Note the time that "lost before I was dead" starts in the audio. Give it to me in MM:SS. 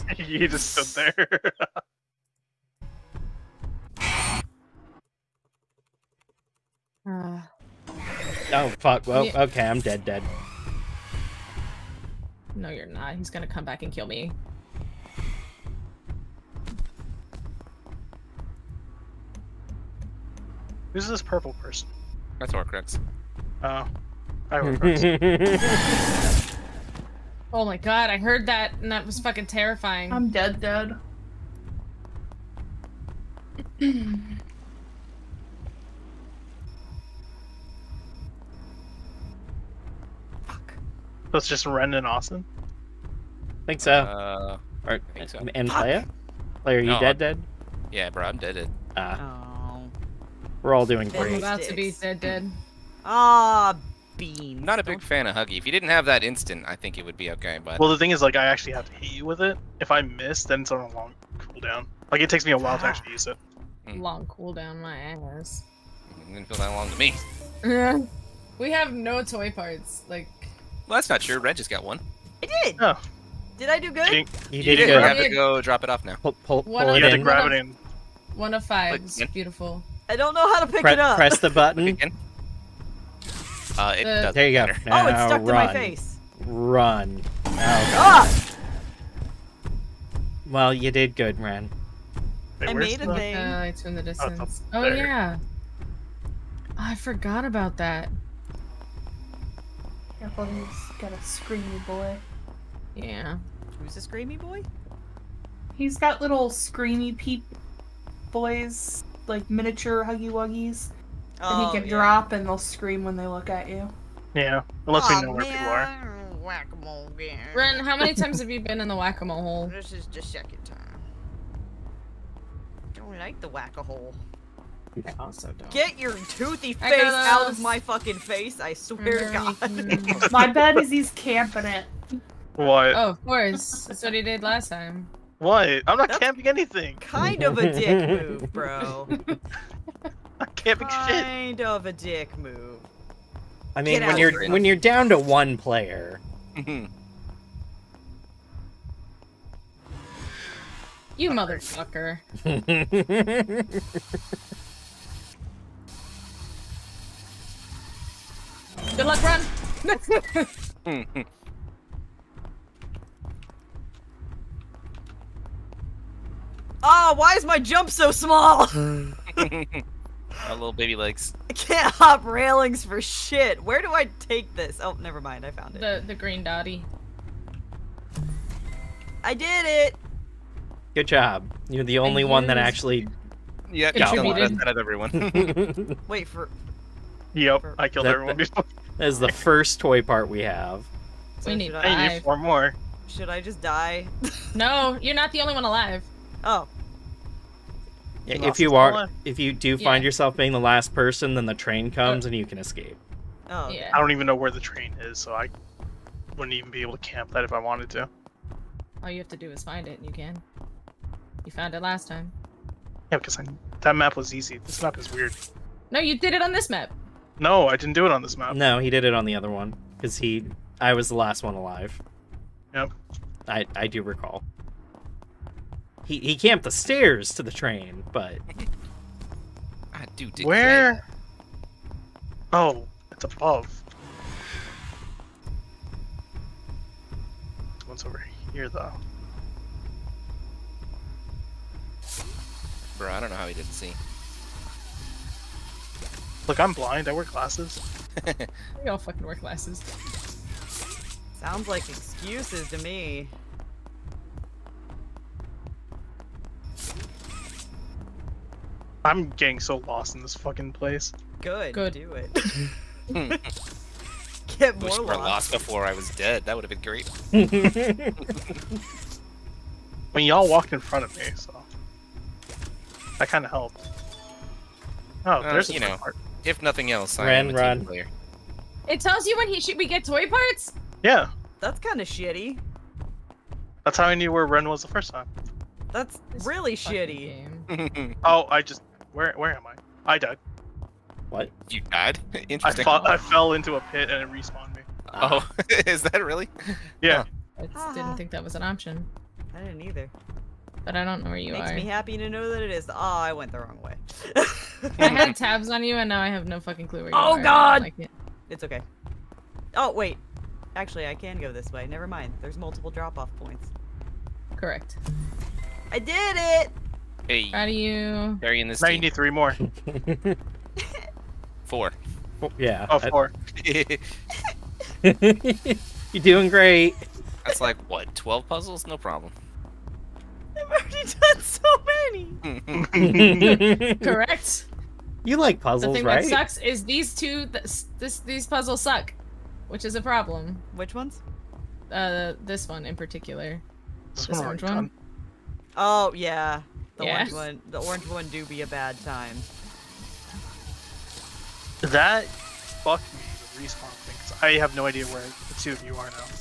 04:25.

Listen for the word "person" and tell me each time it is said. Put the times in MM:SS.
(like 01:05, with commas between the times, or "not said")
00:21, 03:20.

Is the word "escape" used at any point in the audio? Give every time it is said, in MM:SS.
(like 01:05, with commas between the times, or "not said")
03:22.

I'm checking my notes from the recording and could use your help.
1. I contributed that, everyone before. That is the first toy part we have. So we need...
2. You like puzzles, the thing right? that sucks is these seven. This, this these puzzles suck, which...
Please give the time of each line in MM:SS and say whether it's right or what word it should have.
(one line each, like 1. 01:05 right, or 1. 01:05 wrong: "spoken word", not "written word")
1. 03:07 wrong: "killed", not "contributed"
2. 05:35 wrong: "two", not "seven".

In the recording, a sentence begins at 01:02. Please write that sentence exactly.
Like, it takes me a while to actually use it.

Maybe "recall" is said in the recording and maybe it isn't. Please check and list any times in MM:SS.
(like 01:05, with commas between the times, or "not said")
03:44.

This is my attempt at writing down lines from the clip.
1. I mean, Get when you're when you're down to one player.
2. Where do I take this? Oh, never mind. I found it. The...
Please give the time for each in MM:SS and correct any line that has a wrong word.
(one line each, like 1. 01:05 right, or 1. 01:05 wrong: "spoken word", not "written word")
1. 02:23 right
2. 02:53 right.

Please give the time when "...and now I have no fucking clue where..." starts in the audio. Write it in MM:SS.
05:05.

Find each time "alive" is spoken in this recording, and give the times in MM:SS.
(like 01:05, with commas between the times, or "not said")
03:15, 03:41.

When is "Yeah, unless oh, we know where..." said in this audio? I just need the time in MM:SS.
01:54.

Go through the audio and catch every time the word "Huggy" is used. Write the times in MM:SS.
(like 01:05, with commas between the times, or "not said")
00:55, 01:50.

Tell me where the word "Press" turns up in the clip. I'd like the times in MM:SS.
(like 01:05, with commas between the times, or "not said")
01:21.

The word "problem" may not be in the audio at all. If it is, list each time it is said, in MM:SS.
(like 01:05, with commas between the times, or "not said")
05:28, 05:40.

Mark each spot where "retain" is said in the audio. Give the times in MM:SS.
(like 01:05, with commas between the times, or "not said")
not said.